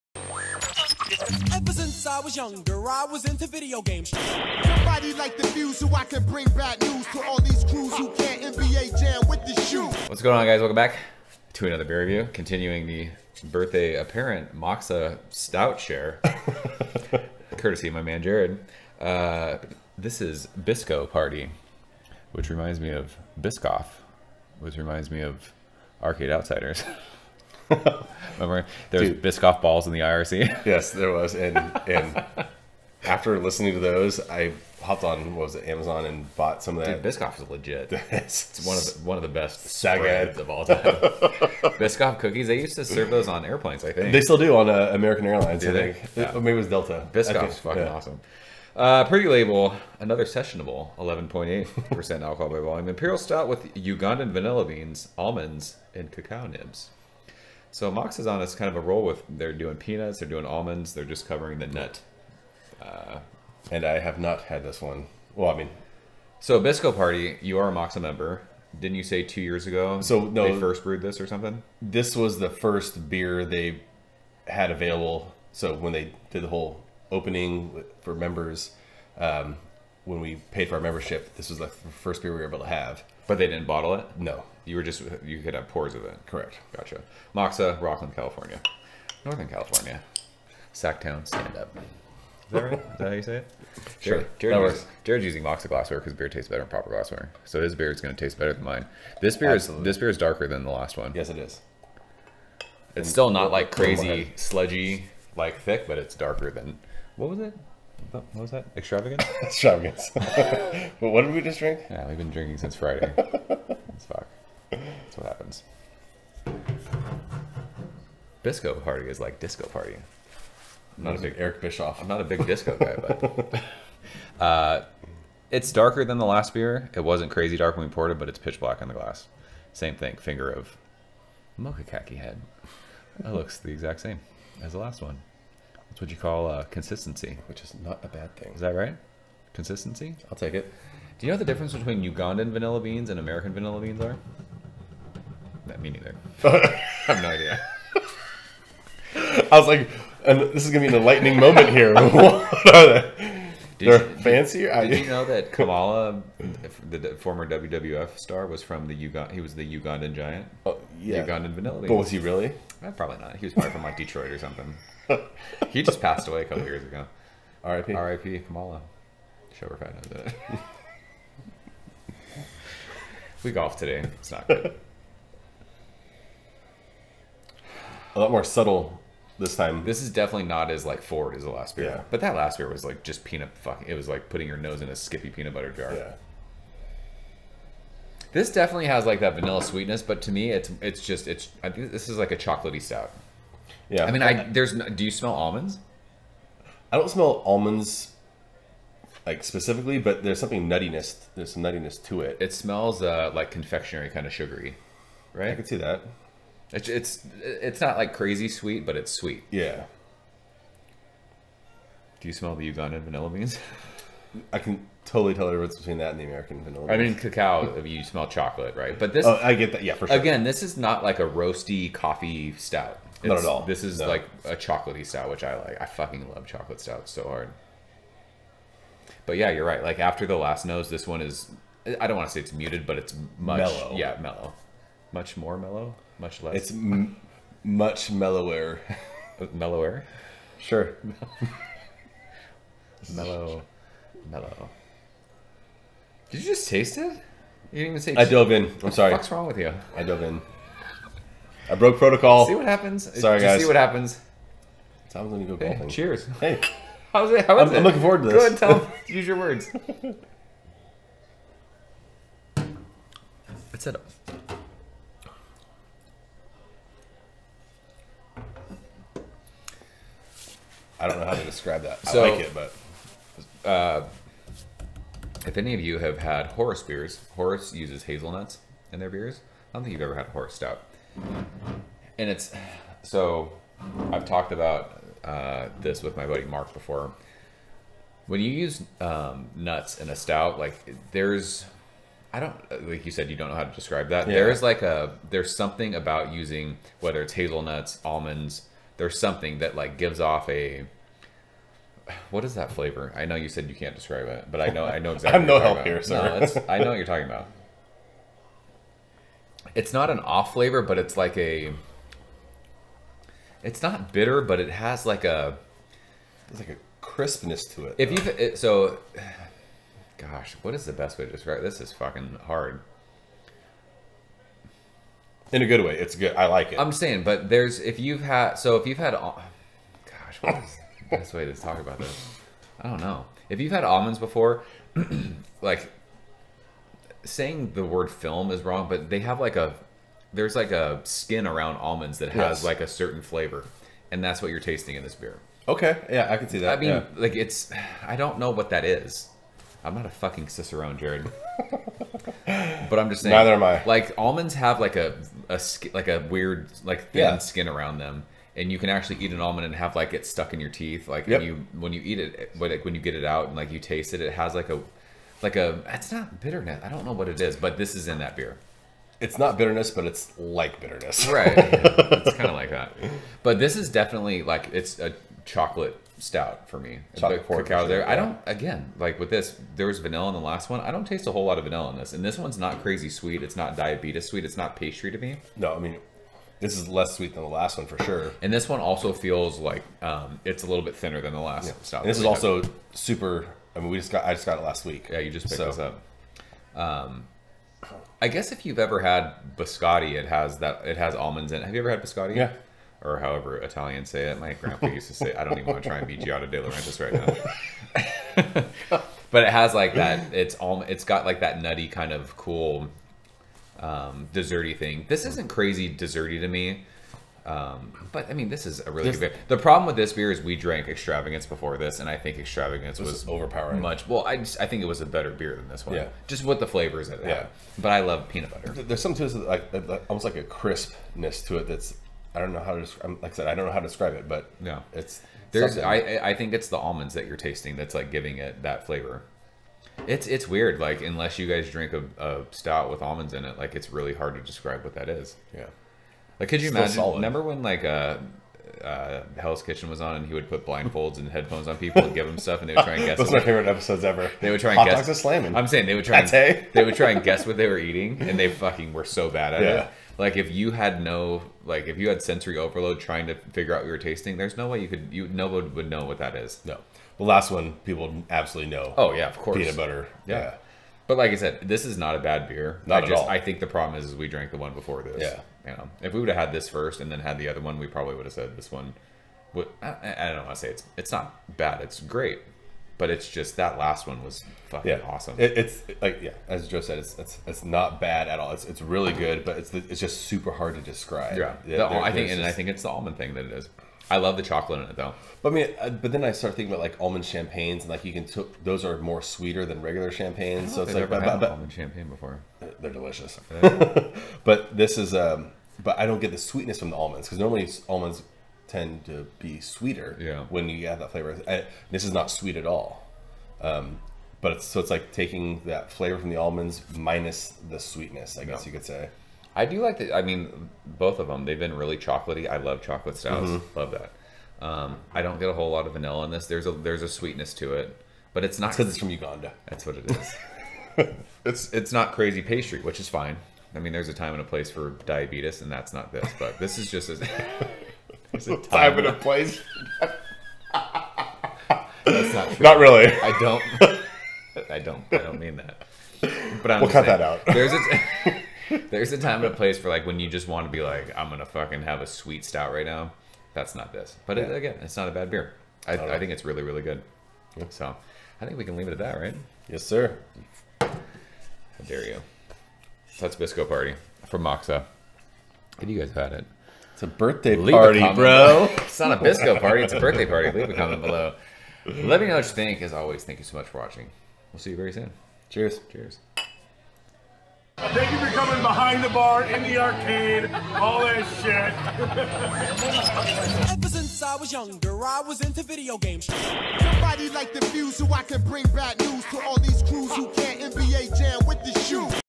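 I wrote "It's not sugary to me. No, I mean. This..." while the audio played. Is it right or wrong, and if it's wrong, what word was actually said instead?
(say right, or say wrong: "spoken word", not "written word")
wrong: "pastry", not "sugary".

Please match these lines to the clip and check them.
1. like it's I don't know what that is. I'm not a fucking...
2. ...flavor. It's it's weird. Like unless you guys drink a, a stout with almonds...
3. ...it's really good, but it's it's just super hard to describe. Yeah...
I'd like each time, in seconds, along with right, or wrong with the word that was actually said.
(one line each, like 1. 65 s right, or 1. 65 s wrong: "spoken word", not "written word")
1. 347 s right
2. 438 s right
3. 488 s right.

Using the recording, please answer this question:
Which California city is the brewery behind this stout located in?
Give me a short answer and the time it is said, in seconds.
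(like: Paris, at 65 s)
Rocklin, at 87 s.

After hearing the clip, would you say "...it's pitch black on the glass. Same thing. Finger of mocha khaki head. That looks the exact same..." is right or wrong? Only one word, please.
right.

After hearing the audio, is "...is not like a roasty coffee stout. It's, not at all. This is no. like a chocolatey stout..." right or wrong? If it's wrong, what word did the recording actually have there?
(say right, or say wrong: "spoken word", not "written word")
right.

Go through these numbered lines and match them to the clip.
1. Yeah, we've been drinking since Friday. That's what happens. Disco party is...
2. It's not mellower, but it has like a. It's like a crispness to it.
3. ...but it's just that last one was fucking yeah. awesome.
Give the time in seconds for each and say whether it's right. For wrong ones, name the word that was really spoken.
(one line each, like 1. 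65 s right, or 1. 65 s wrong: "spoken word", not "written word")
1. 111 s right
2. 313 s wrong: "bitter", not "mellower"
3. 483 s right.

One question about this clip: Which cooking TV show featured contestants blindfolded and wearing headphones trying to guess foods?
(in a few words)
Hell's Kitchen.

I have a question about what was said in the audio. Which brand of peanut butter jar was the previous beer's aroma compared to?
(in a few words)
Skippy.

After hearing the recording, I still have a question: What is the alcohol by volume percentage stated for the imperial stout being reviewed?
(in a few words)
11.8%.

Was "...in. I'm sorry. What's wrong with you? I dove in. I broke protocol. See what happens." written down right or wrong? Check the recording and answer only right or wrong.
right.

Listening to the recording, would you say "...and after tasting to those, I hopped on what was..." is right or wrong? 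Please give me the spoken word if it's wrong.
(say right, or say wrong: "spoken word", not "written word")
wrong: "listening", not "tasting".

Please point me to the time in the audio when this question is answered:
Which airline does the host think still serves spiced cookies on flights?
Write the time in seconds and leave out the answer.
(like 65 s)
44 s.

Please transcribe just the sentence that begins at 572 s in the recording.
As always, thank you so much for watching.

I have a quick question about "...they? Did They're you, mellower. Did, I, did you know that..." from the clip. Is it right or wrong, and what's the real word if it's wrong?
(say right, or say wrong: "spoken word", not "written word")
wrong: "fancier", not "mellower".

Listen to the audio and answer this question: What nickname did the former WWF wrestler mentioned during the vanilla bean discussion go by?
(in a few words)
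The Ugandan giant.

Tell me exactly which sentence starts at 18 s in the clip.
Uh, this is Bisco Party, which reminds me of Biscoff, which reminds me of Arcade Outsiders.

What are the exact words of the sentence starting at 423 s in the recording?
Much well, I just, I think it was a better beer than this one.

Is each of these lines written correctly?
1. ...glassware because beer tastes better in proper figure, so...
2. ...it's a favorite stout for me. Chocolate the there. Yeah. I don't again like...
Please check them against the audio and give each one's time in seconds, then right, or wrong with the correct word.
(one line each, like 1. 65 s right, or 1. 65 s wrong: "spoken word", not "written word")
1. 95 s wrong: "glassware", not "figure"
2. 374 s wrong: "chocolate", not "favorite".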